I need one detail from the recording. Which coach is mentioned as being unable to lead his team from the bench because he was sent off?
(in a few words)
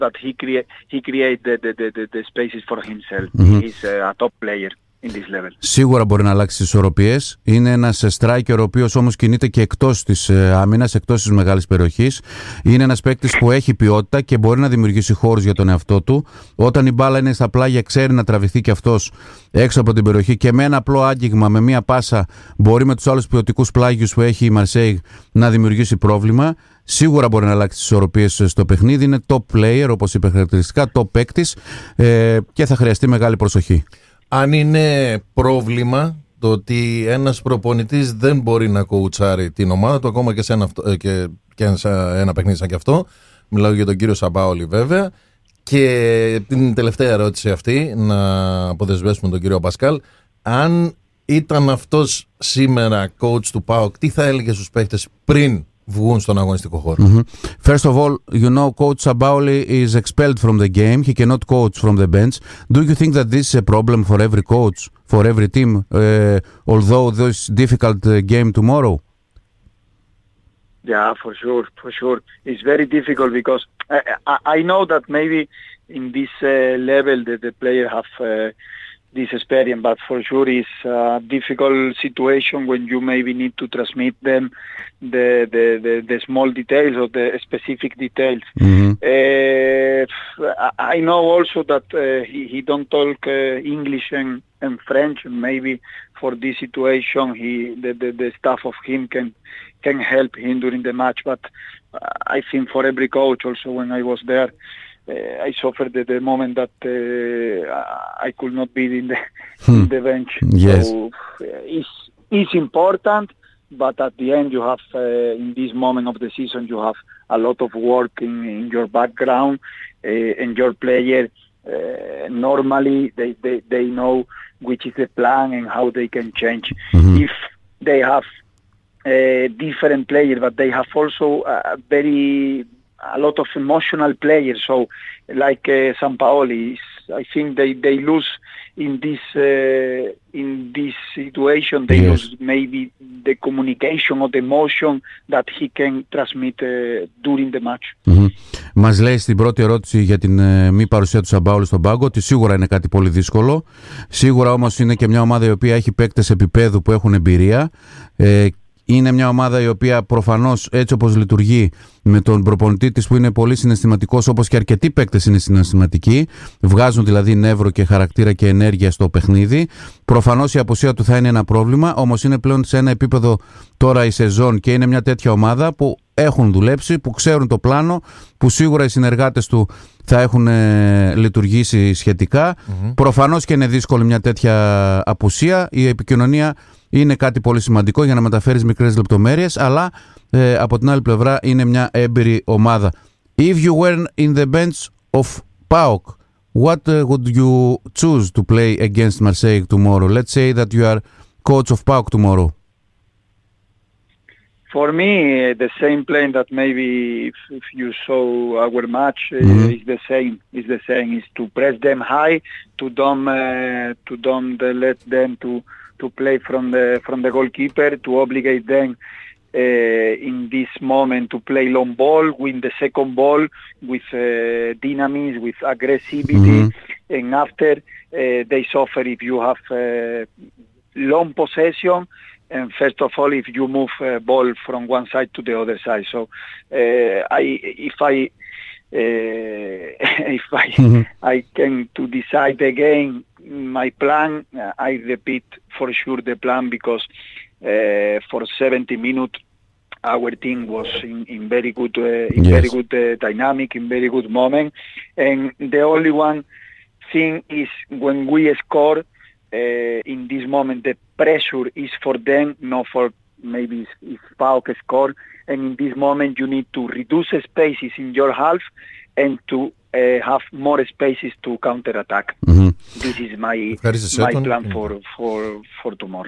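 Sampaoli.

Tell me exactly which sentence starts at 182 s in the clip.
Προφανώς και είναι δύσκολη μια τέτοια απουσία.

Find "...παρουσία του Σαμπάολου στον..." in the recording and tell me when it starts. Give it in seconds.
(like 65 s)
150 s.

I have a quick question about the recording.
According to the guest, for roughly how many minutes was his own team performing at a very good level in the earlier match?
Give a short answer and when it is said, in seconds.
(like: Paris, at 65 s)
70, at 248 s.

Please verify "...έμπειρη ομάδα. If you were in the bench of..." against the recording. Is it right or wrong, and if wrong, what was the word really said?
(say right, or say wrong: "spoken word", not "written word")
right.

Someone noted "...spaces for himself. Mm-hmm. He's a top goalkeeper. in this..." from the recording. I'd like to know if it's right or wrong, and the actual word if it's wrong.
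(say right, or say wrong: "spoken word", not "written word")
wrong: "player", not "goalkeeper".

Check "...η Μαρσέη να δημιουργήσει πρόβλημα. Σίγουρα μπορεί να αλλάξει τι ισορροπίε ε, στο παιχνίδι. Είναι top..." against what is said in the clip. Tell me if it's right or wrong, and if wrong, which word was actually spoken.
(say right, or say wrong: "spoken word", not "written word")
right.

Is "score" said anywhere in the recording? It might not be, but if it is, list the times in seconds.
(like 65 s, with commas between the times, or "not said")
258 s, 264 s.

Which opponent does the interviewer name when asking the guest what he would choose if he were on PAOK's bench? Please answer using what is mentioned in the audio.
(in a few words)
Marseille.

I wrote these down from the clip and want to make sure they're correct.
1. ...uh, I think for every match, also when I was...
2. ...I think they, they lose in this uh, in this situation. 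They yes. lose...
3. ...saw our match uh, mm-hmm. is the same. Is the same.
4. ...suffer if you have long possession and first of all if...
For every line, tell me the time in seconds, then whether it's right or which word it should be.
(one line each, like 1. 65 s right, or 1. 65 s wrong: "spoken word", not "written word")
1. 101 s wrong: "coach", not "match"
2. 137 s right
3. 208 s right
4. 228 s right.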